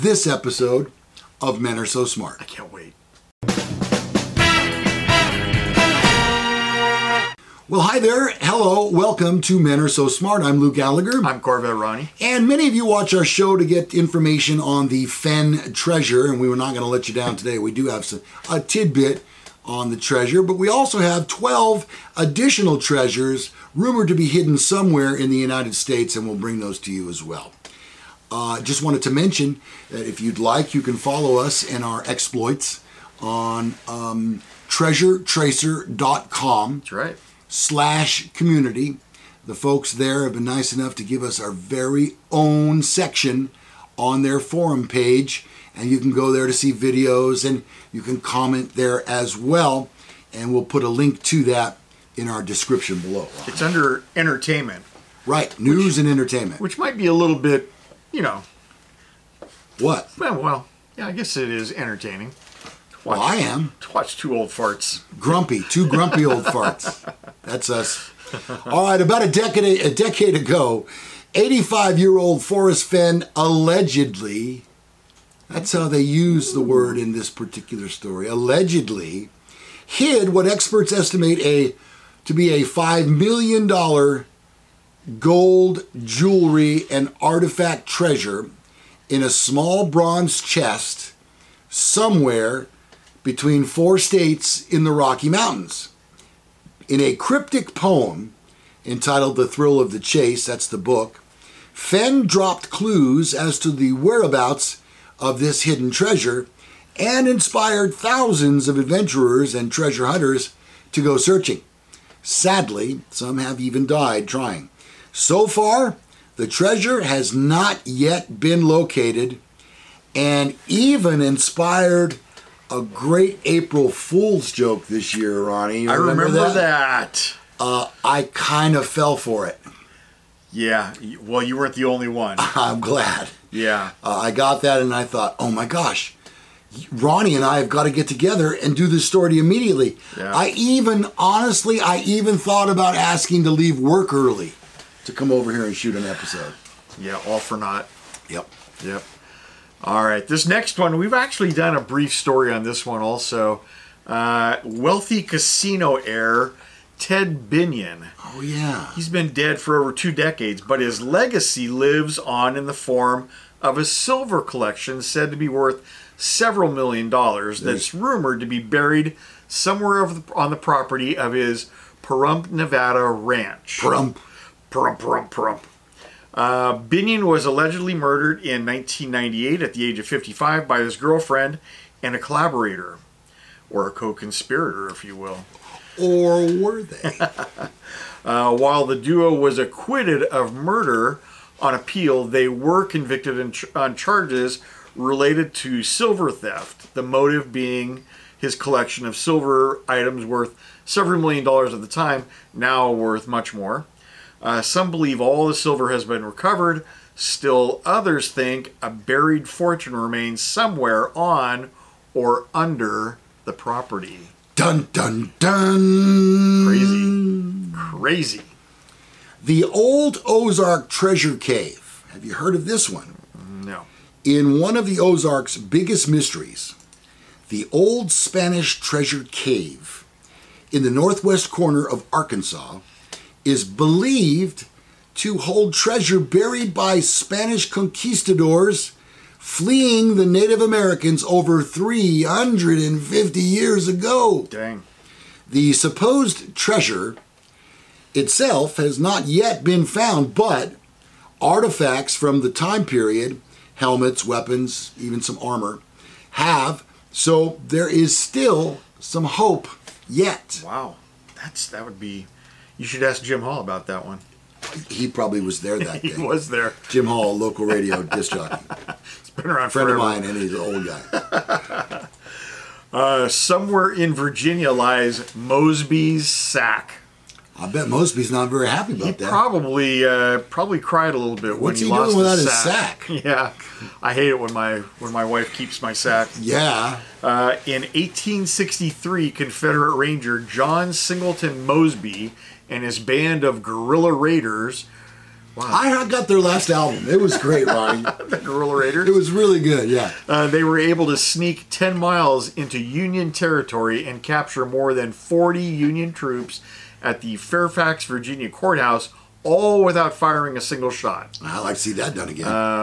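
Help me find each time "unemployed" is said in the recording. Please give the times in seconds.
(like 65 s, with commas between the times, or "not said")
not said.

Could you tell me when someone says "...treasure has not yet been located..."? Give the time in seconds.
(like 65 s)
116 s.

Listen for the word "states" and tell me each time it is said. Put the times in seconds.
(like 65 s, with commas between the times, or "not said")
25 s, 93 s.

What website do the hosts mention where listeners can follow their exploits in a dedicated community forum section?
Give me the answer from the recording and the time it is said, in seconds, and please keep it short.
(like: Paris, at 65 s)
treasuretracer.com, at 34 s.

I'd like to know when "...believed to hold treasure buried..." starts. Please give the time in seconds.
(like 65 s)
233 s.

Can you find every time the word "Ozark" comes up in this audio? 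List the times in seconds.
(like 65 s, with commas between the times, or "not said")
220 s, 224 s.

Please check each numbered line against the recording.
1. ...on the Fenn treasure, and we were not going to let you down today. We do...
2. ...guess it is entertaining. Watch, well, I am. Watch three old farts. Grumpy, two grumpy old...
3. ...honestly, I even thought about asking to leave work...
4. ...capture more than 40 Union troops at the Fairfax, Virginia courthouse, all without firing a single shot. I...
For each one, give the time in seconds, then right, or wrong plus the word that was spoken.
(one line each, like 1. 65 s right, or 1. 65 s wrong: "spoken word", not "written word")
1. 14 s right
2. 61 s wrong: "two", not "three"
3. 141 s right
4. 304 s right.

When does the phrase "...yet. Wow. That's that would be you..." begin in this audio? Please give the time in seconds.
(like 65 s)
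260 s.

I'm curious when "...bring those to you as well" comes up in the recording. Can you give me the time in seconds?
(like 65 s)
26 s.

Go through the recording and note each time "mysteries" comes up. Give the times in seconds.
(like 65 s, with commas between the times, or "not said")
226 s.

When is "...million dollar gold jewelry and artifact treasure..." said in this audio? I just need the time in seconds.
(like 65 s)
83 s.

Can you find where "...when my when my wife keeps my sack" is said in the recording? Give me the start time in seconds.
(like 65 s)
284 s.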